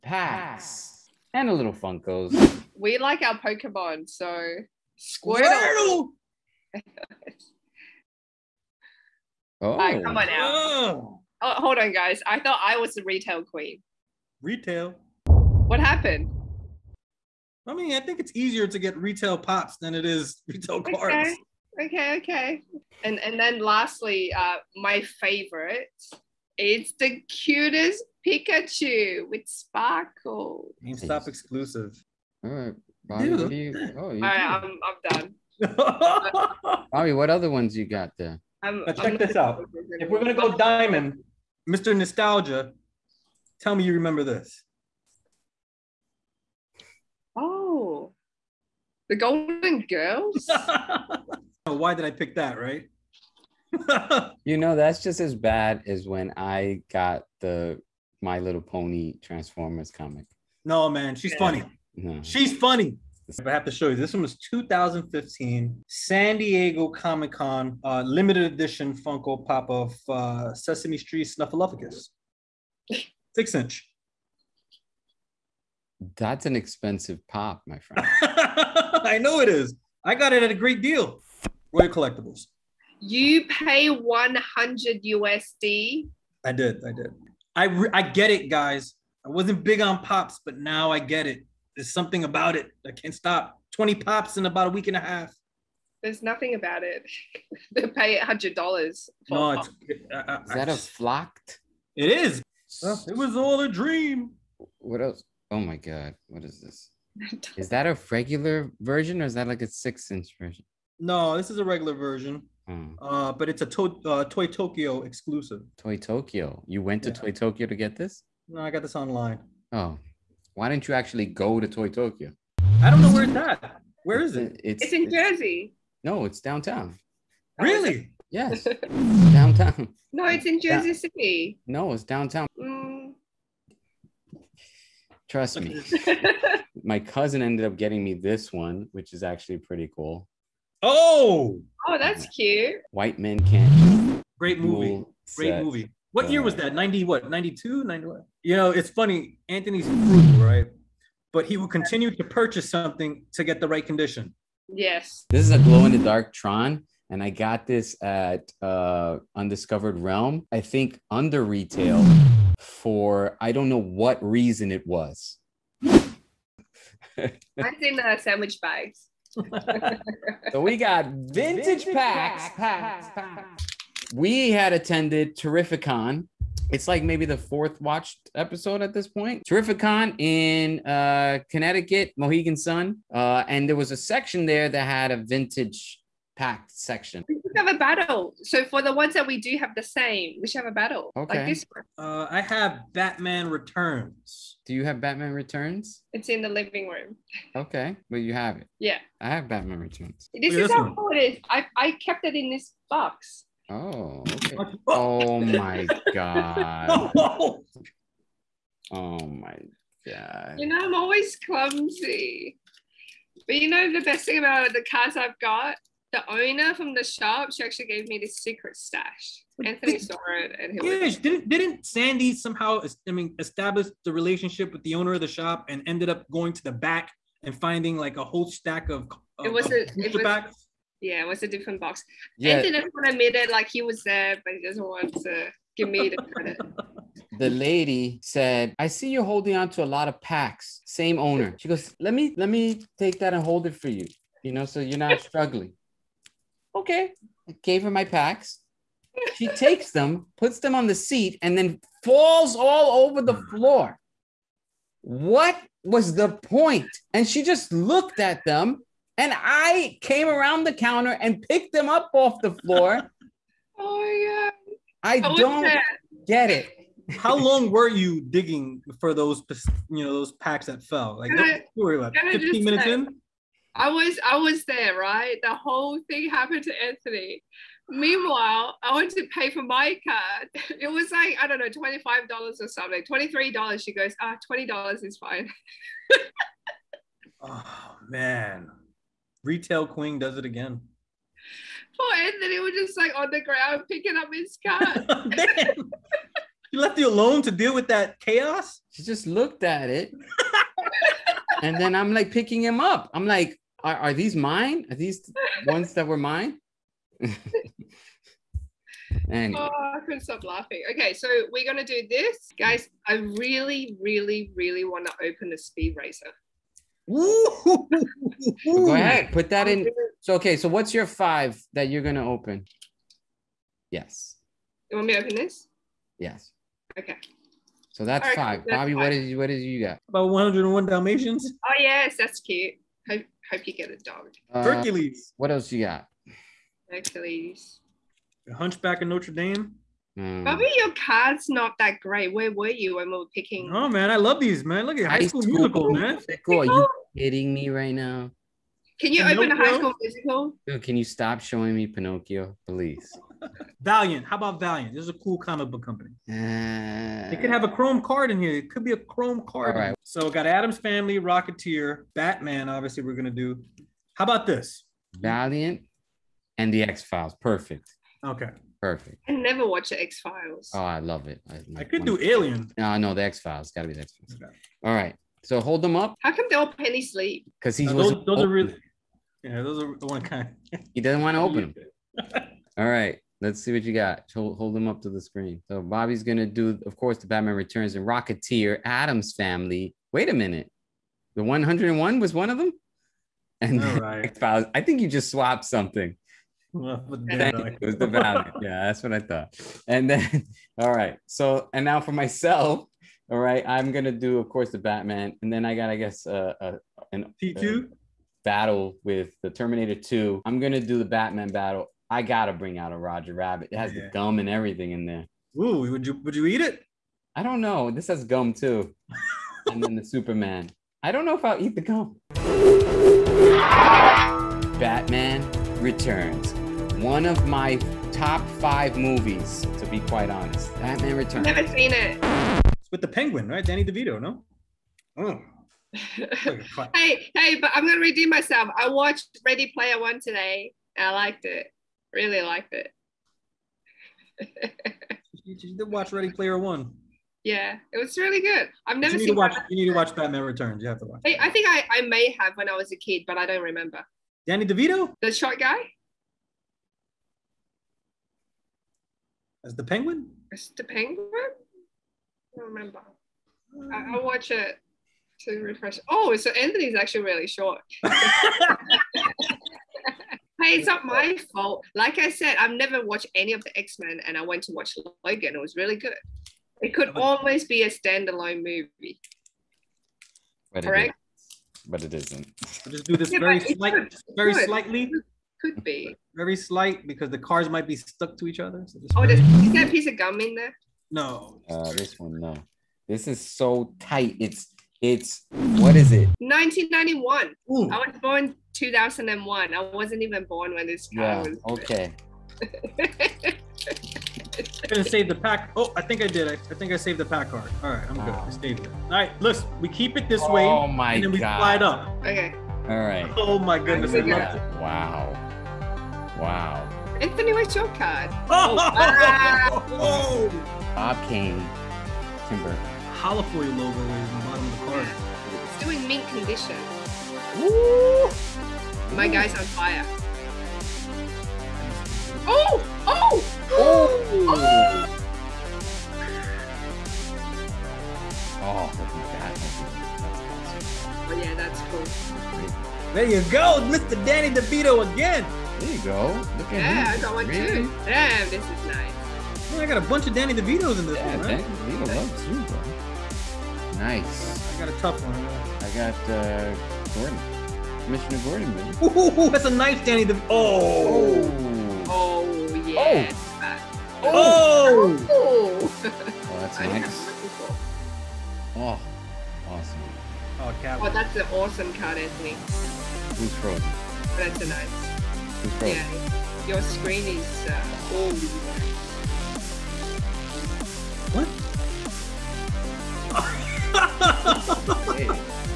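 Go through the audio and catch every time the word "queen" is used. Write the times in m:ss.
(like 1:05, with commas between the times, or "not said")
0:13, 4:49.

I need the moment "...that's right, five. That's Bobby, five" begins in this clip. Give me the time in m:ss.
5:28.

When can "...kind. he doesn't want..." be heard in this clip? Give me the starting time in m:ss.
6:20.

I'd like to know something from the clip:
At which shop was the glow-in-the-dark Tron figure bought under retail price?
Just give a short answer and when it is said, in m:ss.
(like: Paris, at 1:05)
Undiscovered Realm, at 2:39.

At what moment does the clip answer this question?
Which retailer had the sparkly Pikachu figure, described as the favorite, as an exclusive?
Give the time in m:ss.
0:30.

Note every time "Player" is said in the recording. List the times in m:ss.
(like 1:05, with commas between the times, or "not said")
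7:19, 7:26.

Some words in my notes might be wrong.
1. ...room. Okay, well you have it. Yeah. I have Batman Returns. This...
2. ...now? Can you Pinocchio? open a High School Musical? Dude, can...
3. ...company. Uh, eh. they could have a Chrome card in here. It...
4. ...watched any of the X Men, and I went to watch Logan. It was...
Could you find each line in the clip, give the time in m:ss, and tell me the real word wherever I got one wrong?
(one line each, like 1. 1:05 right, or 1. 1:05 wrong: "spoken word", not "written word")
1. 3:16 right
2. 5:47 right
3. 5:55 right
4. 7:53 right.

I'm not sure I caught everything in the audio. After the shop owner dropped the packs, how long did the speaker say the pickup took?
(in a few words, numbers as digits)
15 minutes.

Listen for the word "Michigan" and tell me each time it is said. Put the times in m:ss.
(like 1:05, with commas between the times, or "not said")
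not said.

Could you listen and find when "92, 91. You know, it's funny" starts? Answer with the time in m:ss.
2:27.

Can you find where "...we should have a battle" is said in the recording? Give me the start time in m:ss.
3:10.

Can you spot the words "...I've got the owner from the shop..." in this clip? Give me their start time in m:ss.
3:35.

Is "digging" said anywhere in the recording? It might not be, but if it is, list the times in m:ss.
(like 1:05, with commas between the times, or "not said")
4:28.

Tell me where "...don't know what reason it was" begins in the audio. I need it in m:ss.
2:43.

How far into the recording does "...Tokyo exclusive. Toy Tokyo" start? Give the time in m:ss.
1:54.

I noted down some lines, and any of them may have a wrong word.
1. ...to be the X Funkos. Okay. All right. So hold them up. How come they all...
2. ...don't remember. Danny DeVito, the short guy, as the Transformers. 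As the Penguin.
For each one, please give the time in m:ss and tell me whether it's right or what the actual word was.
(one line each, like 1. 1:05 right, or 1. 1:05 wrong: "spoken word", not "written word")
1. 6:13 wrong: "Files", not "Funkos"
2. 7:33 wrong: "Penguin", not "Transformers".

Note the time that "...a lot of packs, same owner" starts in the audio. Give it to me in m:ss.
3:59.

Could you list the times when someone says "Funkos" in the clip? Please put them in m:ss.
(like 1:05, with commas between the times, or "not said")
0:01, 1:08.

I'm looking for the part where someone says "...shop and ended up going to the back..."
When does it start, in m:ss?
3:45.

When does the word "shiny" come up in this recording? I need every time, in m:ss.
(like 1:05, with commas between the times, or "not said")
not said.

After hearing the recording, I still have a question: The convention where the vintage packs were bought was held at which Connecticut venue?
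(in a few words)
Mohegan Sun.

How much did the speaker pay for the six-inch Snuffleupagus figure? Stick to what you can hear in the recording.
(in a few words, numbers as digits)
$100.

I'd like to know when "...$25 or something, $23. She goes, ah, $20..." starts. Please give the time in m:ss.
4:41.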